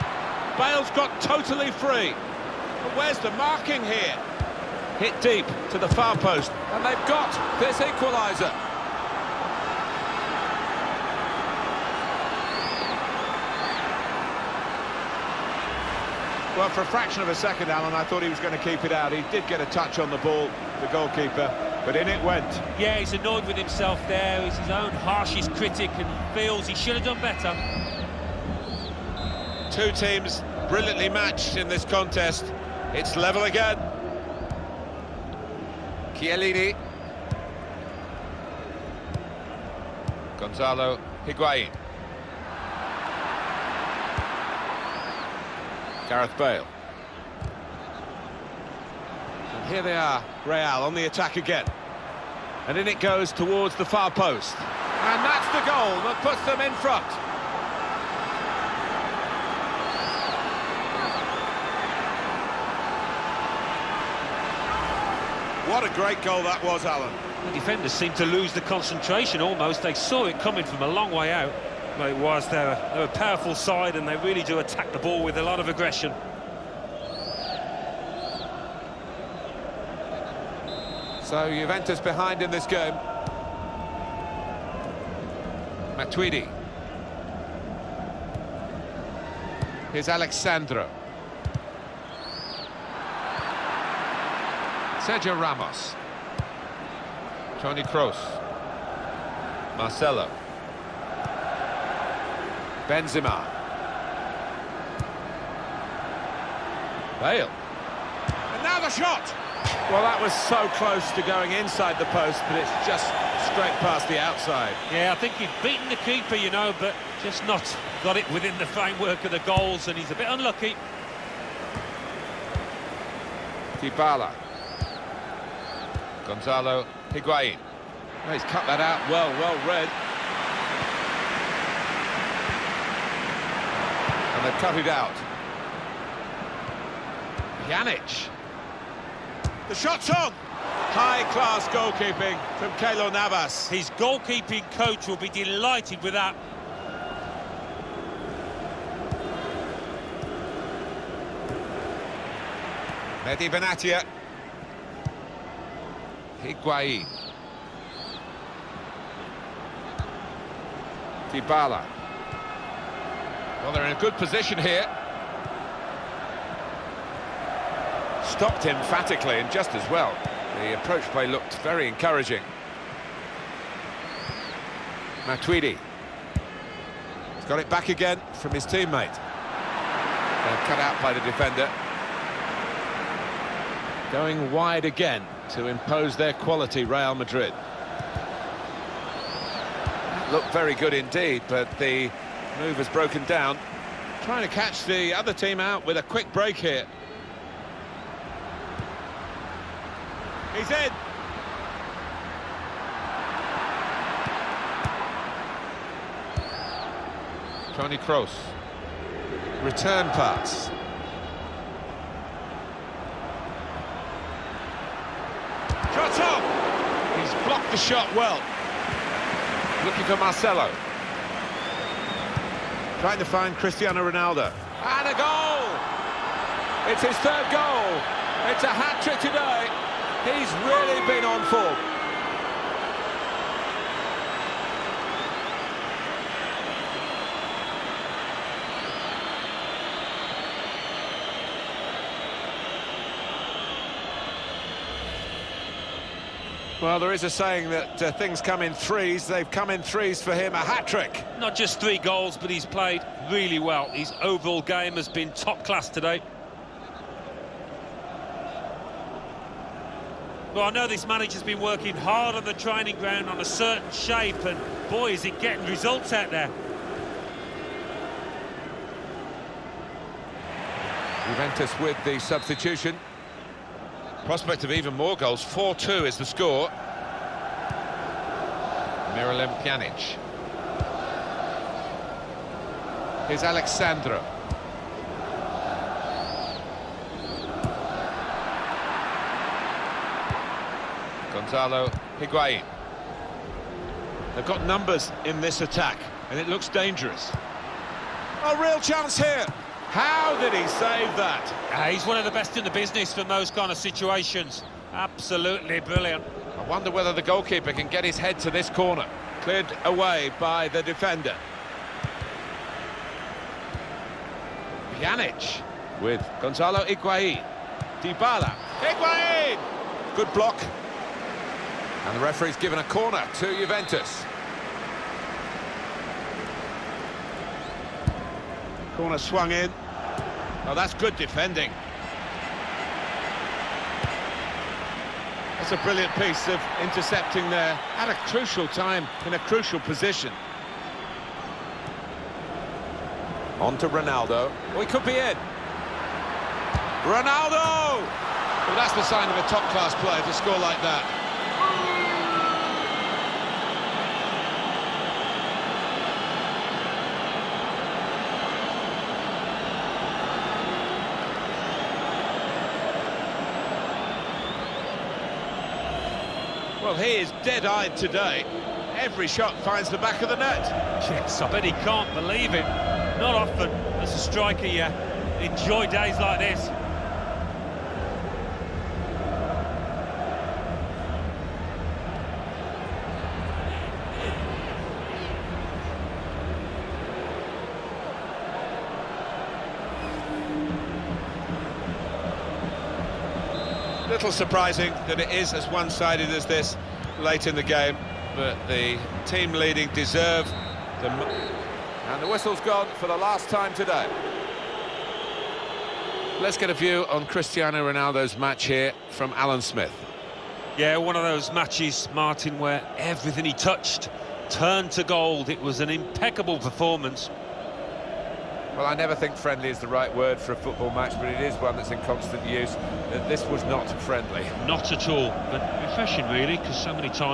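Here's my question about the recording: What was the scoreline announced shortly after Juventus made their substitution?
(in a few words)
4-2.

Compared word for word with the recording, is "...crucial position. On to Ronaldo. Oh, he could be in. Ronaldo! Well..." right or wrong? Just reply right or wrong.
right.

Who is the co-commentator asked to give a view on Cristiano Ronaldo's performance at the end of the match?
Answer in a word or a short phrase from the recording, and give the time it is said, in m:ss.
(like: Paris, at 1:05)
Alan Smith, at 6:49.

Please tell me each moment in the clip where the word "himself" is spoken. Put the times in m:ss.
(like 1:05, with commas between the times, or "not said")
0:23.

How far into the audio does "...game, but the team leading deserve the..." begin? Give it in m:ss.
6:37.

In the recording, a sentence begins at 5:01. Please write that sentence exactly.
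Uh, he's one of the best in the business from those kind of situations.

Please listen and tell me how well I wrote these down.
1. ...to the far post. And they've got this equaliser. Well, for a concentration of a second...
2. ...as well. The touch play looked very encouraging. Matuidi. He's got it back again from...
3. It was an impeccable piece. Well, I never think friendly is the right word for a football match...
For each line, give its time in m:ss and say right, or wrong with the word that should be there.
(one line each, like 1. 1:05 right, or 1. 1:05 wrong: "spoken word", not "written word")
1. 0:05 wrong: "fraction", not "concentration"
2. 2:49 wrong: "approach", not "touch"
3. 6:55 wrong: "performance", not "piece".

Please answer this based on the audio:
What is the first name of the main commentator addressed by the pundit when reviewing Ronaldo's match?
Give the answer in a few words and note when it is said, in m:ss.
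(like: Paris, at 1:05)
Martin, at 6:52.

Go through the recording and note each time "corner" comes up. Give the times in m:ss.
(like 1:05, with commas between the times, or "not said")
5:08, 5:22, 5:29.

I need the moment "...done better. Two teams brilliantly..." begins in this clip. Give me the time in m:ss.
0:27.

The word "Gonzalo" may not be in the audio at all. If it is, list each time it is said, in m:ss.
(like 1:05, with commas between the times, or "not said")
0:40, 2:06, 4:51, 5:16.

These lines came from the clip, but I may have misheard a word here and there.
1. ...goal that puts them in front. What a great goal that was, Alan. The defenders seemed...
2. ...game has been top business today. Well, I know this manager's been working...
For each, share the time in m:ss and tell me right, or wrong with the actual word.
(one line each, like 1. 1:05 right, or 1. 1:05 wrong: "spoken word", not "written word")
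1. 0:55 right
2. 4:14 wrong: "class", not "business".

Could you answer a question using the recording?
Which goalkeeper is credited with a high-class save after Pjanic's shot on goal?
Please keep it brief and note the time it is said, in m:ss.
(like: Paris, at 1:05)
Keylor Navas, at 2:22.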